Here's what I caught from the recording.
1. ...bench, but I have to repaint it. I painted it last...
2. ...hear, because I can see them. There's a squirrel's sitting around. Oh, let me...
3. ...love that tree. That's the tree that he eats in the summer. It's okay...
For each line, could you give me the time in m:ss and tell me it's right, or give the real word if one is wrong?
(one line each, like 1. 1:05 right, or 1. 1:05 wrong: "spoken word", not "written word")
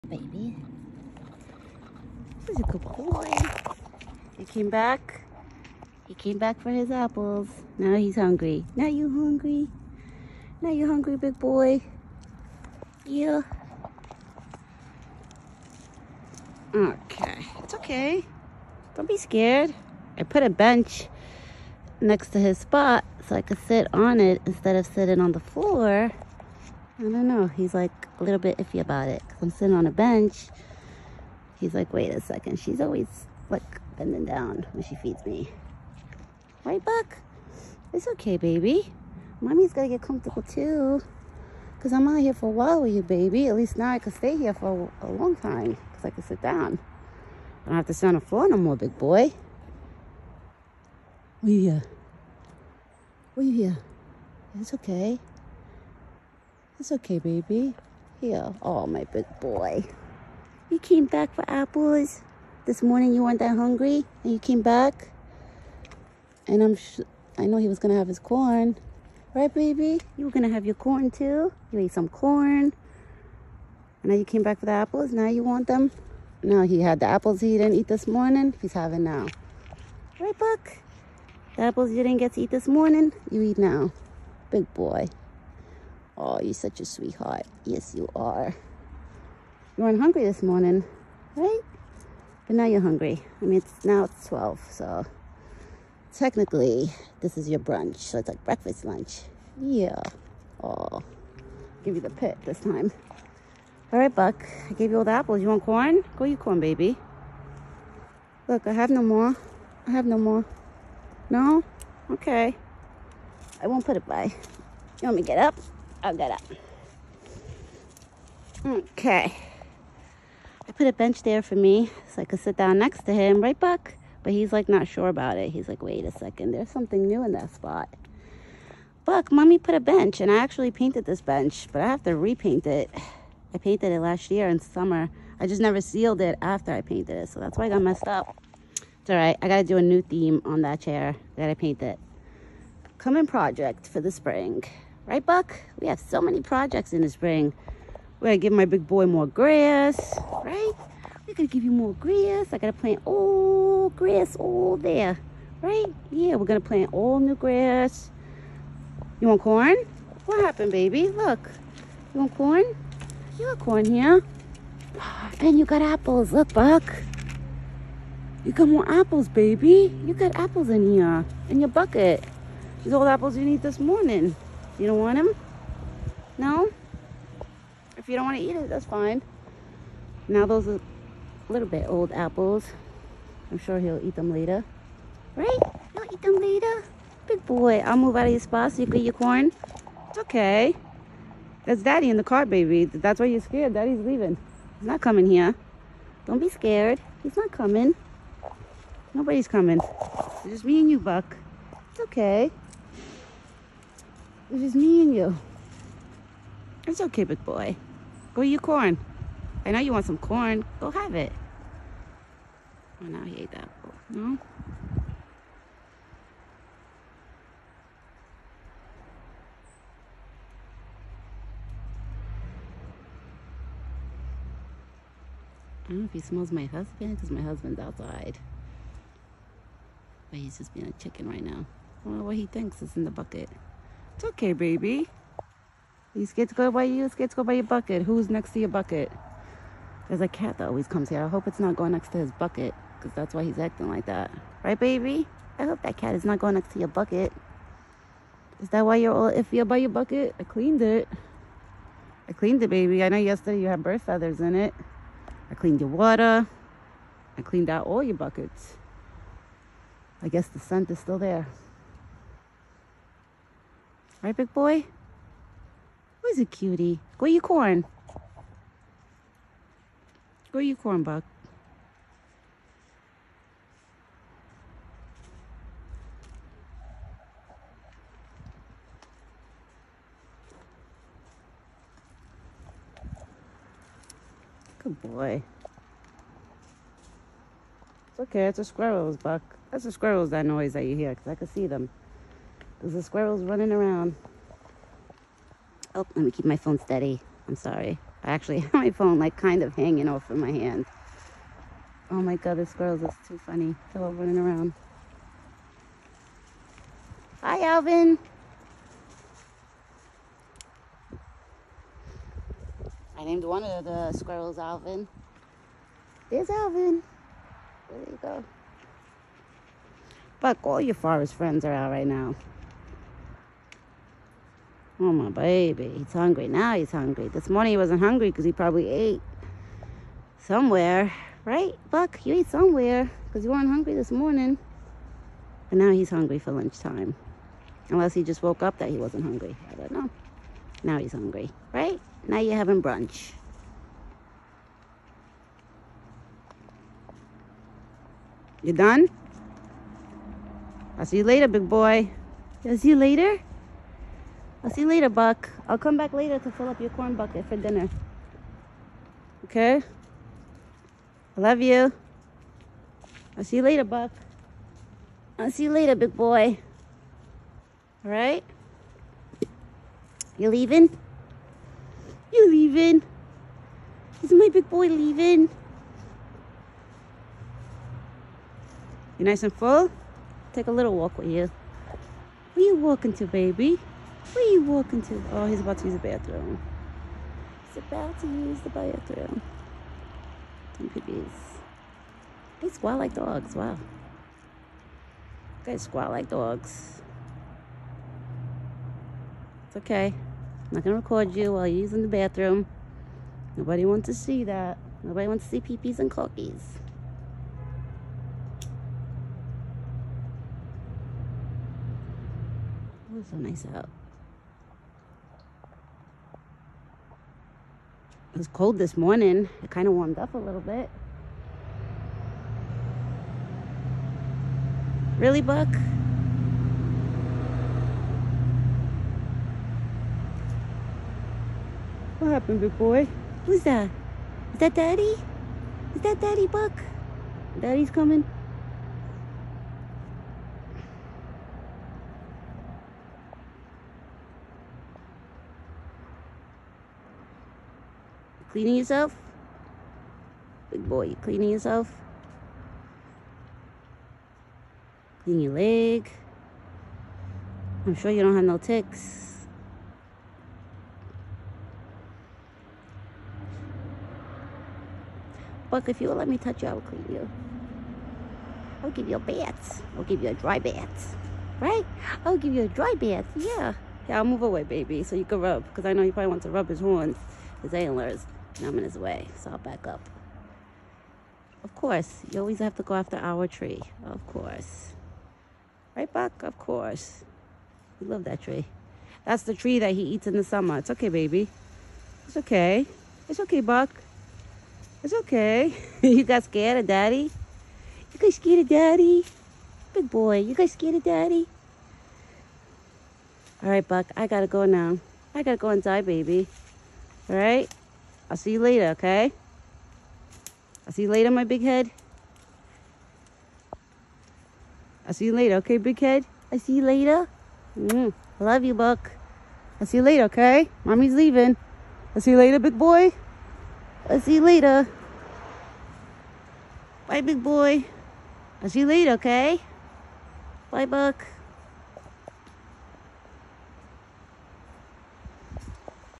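1. 2:11 right
2. 4:50 wrong: "running", not "sitting"
3. 8:08 right.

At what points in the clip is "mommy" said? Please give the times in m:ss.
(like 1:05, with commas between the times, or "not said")
0:39, 2:09, 8:40.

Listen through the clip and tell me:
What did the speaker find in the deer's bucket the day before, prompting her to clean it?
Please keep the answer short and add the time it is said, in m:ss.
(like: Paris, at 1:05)
Bird feathers, at 4:13.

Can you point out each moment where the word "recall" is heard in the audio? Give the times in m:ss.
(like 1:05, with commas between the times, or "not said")
not said.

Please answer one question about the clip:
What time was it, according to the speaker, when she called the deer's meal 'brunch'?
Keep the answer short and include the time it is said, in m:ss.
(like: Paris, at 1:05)
12, at 1:34.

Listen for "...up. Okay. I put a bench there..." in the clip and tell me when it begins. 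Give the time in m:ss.
1:56.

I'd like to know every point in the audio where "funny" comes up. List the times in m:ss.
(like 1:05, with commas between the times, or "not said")
5:03.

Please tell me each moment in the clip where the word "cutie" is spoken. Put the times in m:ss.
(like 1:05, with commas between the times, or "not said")
4:26.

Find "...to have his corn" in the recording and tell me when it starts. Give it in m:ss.
1:07.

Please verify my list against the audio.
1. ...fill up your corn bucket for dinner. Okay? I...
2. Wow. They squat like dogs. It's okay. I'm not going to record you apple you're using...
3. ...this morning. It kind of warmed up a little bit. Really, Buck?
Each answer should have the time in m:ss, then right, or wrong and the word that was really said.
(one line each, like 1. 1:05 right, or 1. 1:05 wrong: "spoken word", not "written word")
1. 5:56 right
2. 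6:33 wrong: "while", not "apple"
3. 6:58 right.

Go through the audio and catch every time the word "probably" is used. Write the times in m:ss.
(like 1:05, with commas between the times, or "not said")
5:28, 7:56.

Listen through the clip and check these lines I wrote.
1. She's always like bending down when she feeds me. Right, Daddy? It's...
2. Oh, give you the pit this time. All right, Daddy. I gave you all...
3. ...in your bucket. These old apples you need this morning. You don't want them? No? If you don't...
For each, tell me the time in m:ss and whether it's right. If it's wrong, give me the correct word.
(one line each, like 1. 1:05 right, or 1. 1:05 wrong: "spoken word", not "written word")
1. 0:32 wrong: "Buck", not "Daddy"
2. 1:40 wrong: "Buck", not "Daddy"
3. 2:51 right.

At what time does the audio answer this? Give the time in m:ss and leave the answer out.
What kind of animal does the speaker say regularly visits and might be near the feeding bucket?
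4:00.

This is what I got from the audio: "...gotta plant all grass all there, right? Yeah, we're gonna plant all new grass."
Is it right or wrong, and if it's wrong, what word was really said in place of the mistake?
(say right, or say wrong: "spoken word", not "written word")
right.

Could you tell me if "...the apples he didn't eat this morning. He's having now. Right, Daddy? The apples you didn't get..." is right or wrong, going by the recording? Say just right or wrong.
wrong.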